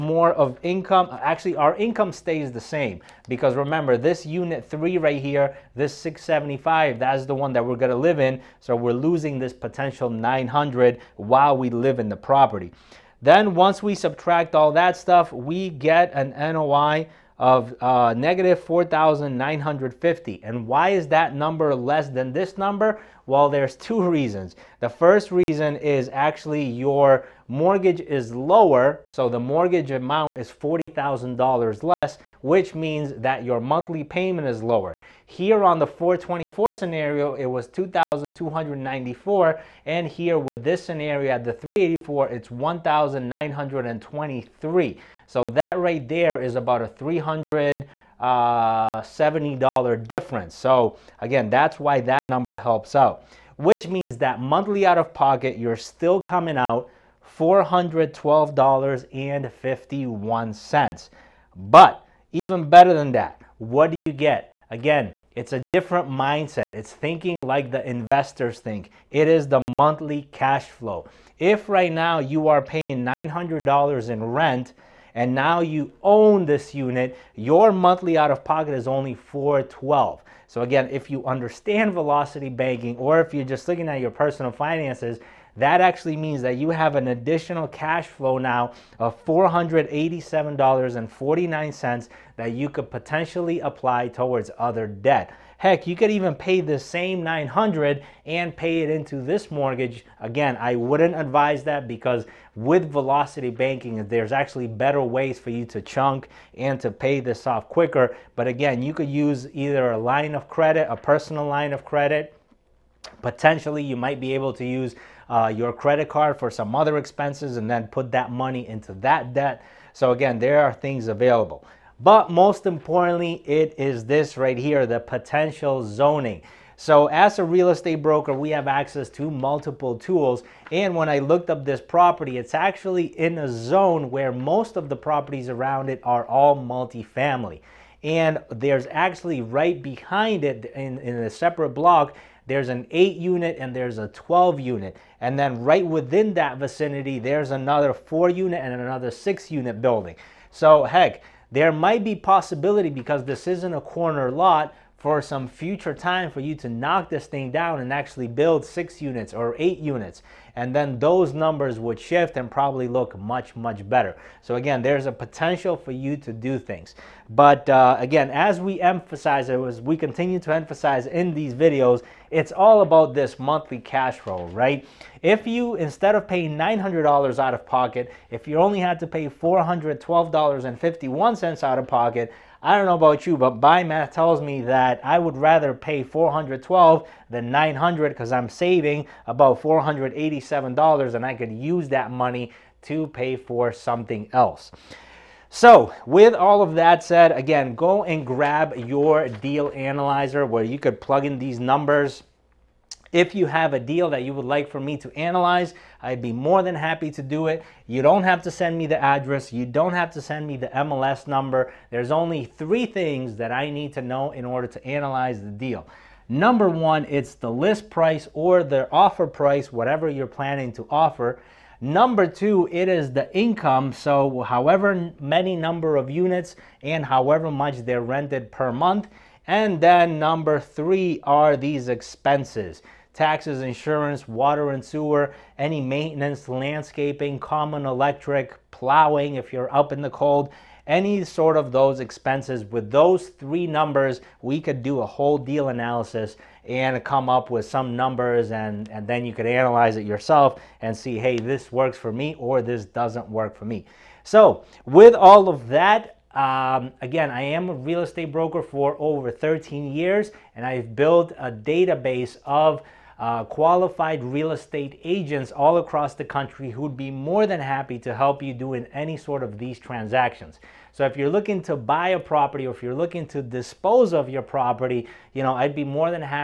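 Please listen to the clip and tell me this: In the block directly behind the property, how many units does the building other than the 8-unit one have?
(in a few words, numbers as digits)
12.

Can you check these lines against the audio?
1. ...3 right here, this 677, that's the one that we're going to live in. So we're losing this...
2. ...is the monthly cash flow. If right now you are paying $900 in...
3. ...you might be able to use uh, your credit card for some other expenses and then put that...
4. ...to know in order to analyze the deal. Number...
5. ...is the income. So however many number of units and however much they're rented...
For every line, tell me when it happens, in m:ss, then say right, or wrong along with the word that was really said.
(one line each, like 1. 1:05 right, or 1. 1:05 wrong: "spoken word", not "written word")
1. 0:04 wrong: "675", not "677"
2. 1:09 right
3. 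1:53 right
4. 3:33 right
5. 3:42 right.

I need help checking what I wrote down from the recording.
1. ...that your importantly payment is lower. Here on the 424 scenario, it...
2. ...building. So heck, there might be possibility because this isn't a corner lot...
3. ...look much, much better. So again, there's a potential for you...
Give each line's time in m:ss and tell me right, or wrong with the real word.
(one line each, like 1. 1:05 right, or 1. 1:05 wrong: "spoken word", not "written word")
1. 0:33 wrong: "monthly", not "importantly"
2. 2:29 right
3. 2:42 right.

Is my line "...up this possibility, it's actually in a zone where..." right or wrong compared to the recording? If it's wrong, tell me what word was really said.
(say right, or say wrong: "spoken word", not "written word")
wrong: "property", not "possibility".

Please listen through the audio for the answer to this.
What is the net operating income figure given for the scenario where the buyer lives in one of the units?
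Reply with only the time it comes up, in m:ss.
0:18.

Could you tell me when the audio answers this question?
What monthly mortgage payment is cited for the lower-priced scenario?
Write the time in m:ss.
0:42.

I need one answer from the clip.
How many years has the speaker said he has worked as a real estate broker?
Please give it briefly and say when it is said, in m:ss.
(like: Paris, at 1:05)
13, at 4:19.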